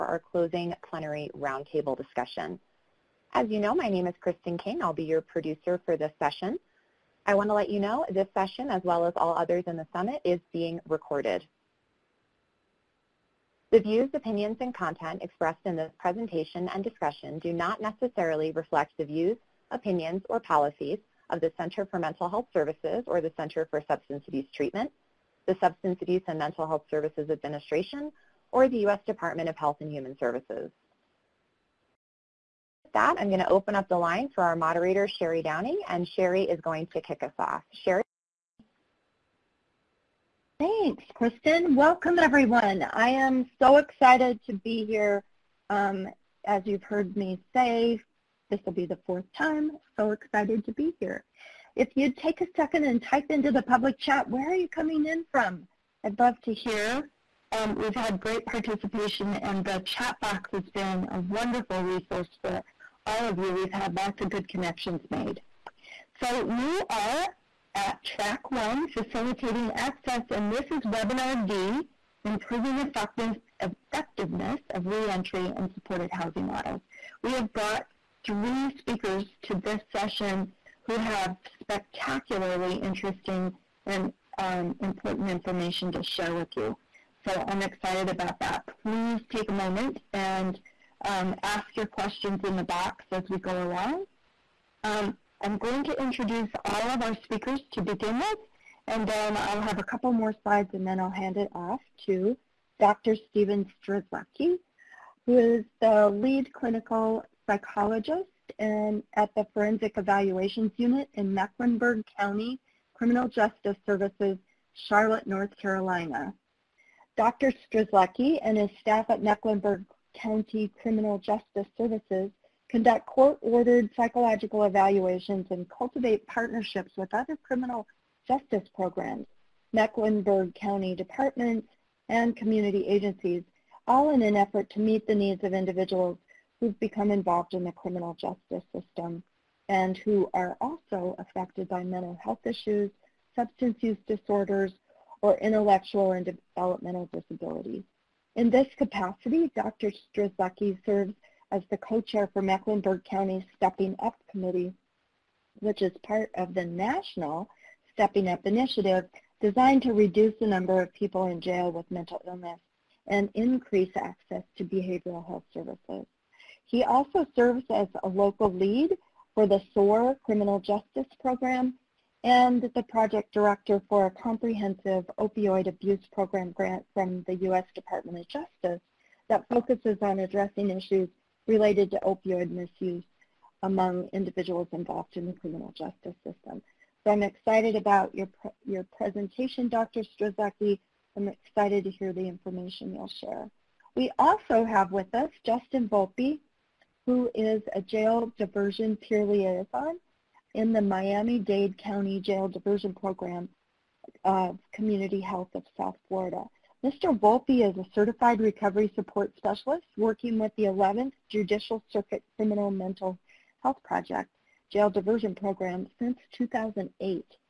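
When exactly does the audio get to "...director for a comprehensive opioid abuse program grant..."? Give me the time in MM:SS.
02:53.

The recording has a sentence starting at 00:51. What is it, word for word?
If you'd take a second and type into the public chat, where are you coming in from?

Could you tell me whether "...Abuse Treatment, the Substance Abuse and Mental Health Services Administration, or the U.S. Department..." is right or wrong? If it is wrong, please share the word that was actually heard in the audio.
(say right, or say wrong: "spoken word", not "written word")
right.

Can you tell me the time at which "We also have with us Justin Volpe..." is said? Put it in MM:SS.
03:13.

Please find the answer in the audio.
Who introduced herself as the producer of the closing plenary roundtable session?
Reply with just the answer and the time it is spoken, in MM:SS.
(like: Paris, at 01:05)
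Kristen King, at 00:04.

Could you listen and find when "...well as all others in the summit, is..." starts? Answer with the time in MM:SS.
00:08.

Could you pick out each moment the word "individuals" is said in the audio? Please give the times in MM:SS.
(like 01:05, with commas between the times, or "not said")
02:15, 03:04.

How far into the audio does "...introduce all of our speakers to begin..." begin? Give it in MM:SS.
01:36.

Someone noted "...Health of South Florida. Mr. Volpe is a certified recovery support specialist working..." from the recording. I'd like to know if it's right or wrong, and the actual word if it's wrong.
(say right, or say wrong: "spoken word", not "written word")
right.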